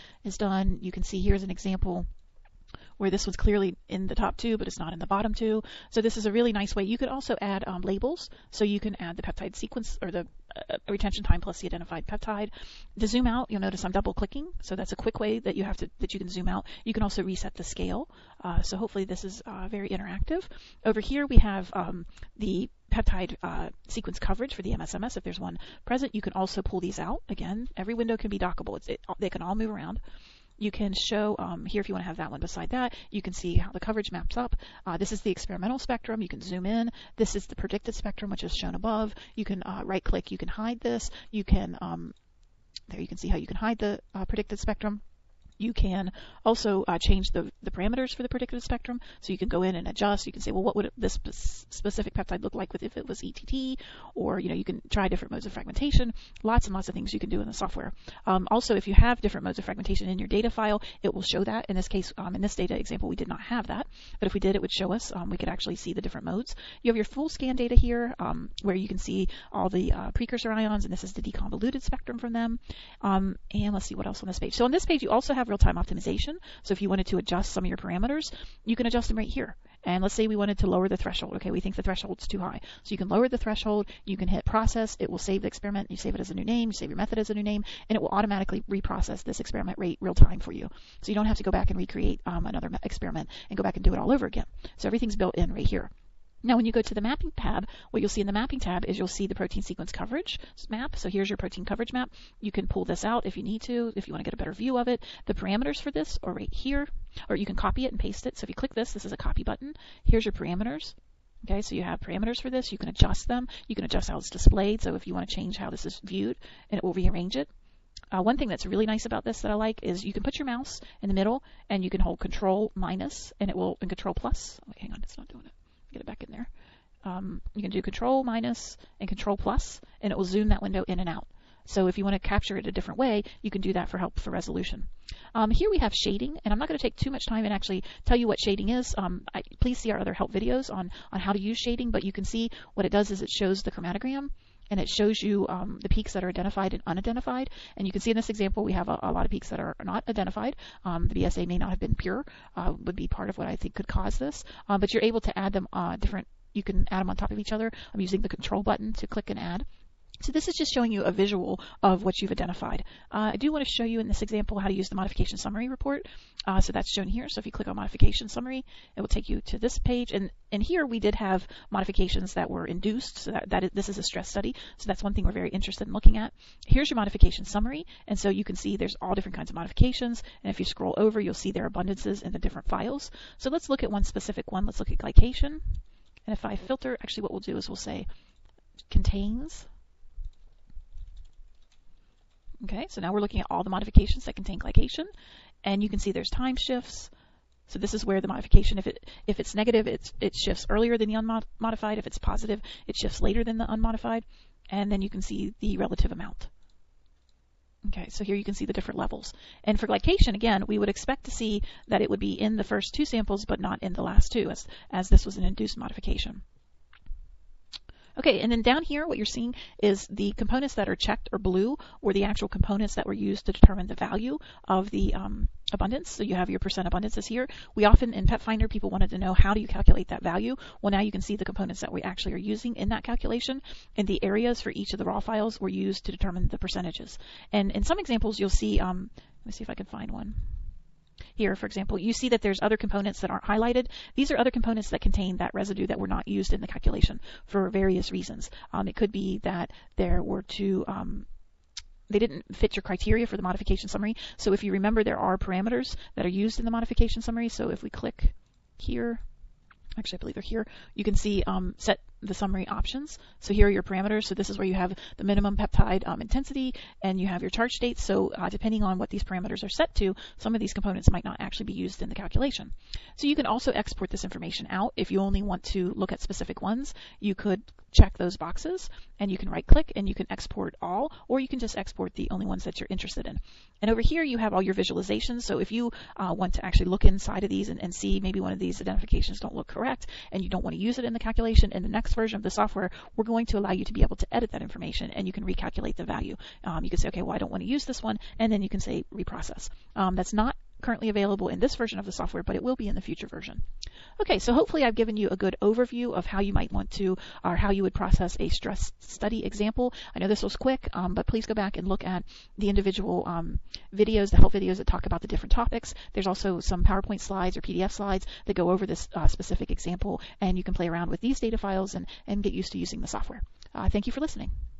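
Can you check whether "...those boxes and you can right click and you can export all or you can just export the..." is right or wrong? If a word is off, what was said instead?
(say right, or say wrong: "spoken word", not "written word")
right.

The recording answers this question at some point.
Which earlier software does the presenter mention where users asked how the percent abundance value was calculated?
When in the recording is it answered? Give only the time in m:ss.
3:48.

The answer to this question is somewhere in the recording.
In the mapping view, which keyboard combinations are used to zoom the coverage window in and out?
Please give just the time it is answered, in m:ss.
2:07.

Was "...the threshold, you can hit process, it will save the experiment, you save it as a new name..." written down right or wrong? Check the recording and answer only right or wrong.
right.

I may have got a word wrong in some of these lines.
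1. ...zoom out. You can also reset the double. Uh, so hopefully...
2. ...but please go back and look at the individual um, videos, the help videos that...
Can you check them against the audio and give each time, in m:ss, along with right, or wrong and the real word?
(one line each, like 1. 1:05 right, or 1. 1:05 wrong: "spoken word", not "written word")
1. 0:16 wrong: "scale", not "double"
2. 5:11 right.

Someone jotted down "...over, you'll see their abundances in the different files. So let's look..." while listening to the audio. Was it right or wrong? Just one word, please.
right.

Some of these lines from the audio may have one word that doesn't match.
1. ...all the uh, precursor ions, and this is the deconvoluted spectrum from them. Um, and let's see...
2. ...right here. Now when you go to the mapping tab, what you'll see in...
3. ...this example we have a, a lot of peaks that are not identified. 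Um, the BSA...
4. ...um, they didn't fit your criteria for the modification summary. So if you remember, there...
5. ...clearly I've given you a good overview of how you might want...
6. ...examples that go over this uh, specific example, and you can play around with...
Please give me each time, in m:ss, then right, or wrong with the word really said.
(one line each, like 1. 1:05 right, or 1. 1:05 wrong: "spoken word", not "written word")
1. 1:09 right
2. 1:35 right
3. 2:28 right
4. 4:10 right
5. 5:04 wrong: "hopefully", not "clearly"
6. 5:17 wrong: "slides", not "examples".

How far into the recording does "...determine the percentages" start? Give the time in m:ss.
3:56.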